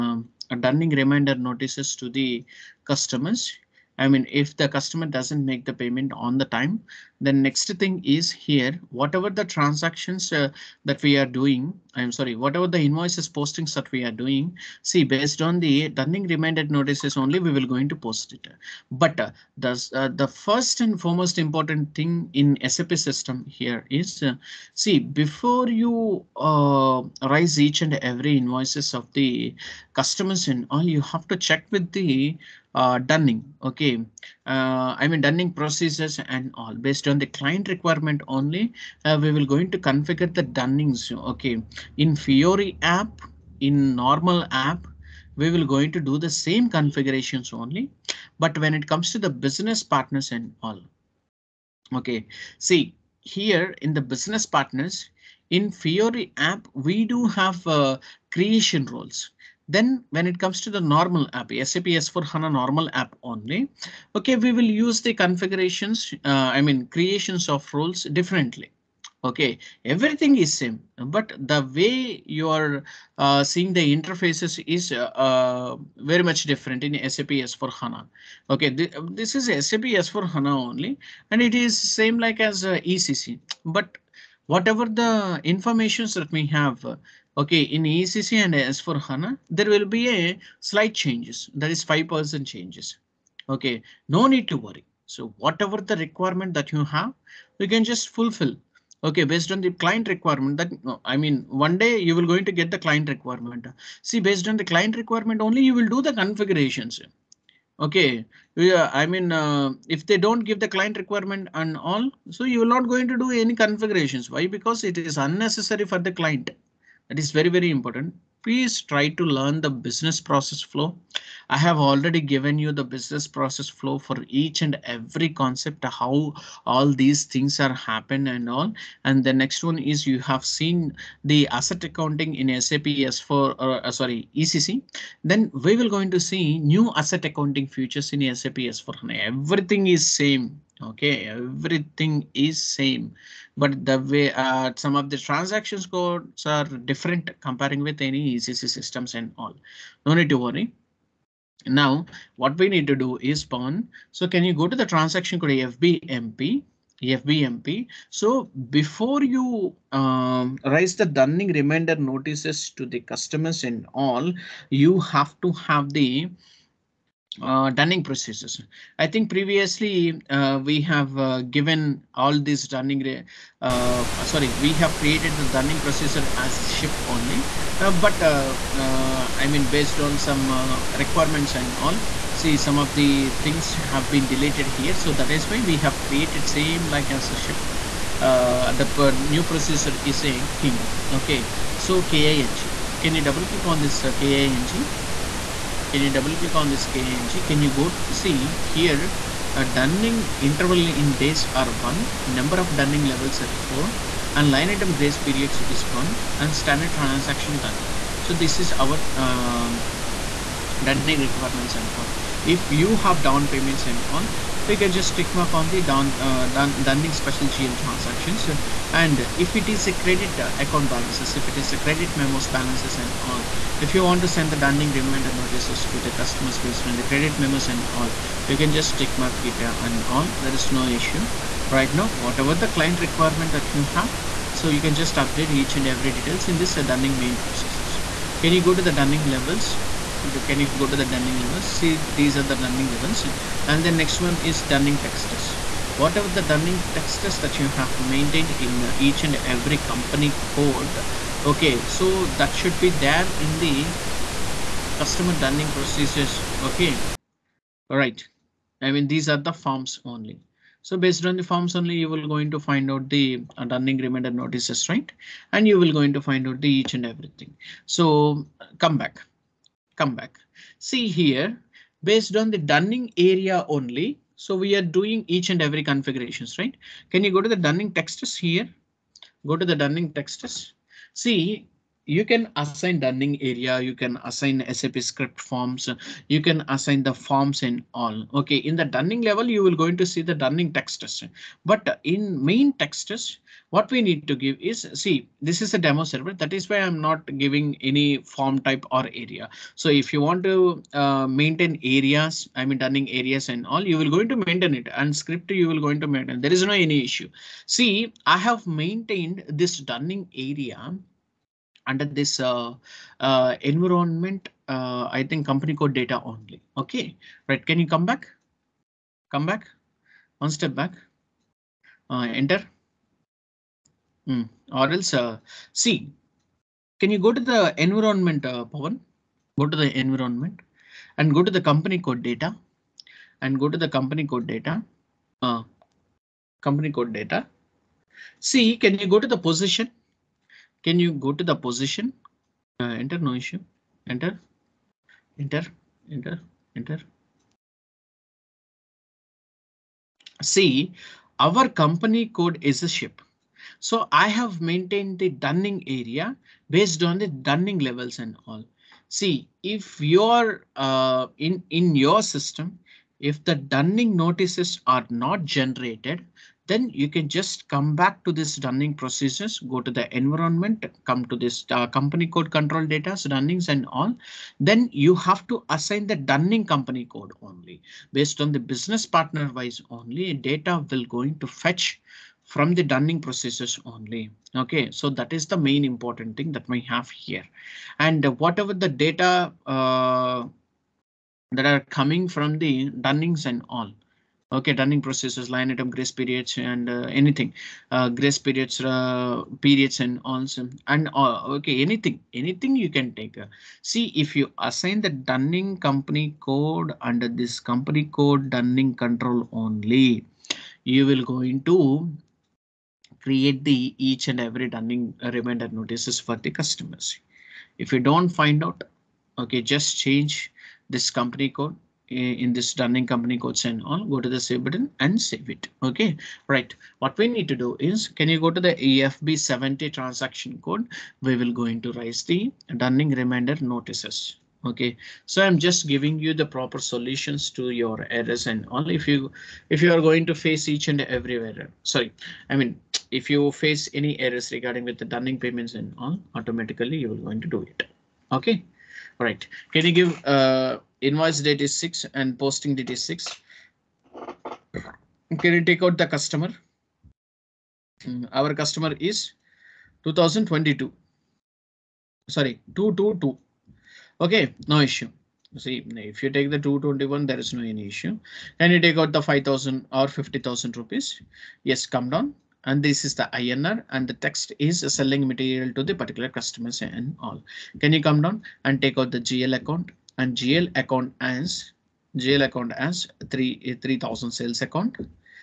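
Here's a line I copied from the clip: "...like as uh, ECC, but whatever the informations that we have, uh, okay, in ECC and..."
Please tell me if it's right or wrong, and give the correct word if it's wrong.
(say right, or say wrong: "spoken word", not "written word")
right.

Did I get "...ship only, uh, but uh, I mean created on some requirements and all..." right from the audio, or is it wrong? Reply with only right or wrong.
wrong.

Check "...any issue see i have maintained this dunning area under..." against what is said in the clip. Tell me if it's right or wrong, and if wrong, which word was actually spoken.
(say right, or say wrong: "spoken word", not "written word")
right.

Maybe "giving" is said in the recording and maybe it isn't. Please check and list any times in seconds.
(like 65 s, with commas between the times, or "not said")
297 s, 435 s.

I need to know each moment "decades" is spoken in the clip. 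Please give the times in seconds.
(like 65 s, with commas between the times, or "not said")
not said.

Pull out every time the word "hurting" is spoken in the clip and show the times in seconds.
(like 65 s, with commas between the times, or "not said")
not said.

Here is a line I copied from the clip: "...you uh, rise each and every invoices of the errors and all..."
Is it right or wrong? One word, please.
wrong.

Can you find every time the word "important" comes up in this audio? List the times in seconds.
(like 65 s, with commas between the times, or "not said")
21 s, 117 s, 385 s.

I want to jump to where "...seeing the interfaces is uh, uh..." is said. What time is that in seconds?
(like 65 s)
73 s.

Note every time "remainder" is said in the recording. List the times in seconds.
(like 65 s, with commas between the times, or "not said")
264 s.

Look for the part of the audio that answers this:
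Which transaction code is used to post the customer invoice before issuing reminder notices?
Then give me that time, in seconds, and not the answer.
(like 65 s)
428 s.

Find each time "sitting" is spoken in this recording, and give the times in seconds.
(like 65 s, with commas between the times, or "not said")
not said.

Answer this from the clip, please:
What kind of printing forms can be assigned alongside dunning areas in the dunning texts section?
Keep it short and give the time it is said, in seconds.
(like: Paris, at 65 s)
SAP script forms, at 284 s.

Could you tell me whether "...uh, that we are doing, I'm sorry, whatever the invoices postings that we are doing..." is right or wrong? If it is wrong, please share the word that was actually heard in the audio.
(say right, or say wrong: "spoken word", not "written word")
right.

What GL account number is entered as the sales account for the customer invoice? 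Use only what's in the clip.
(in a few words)
3000.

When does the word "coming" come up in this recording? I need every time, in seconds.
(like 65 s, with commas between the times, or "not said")
391 s.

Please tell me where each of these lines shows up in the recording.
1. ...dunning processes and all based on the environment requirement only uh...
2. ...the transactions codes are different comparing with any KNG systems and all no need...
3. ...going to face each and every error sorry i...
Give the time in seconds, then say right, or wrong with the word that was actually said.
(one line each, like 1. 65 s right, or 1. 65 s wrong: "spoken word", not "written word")
1. 35 s wrong: "client", not "environment"
2. 145 s wrong: "ECC", not "KNG"
3. 440 s right.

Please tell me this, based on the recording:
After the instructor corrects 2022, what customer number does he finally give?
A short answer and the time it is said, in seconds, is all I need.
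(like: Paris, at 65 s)
222, at 462 s.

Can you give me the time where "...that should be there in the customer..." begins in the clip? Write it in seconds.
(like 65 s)
252 s.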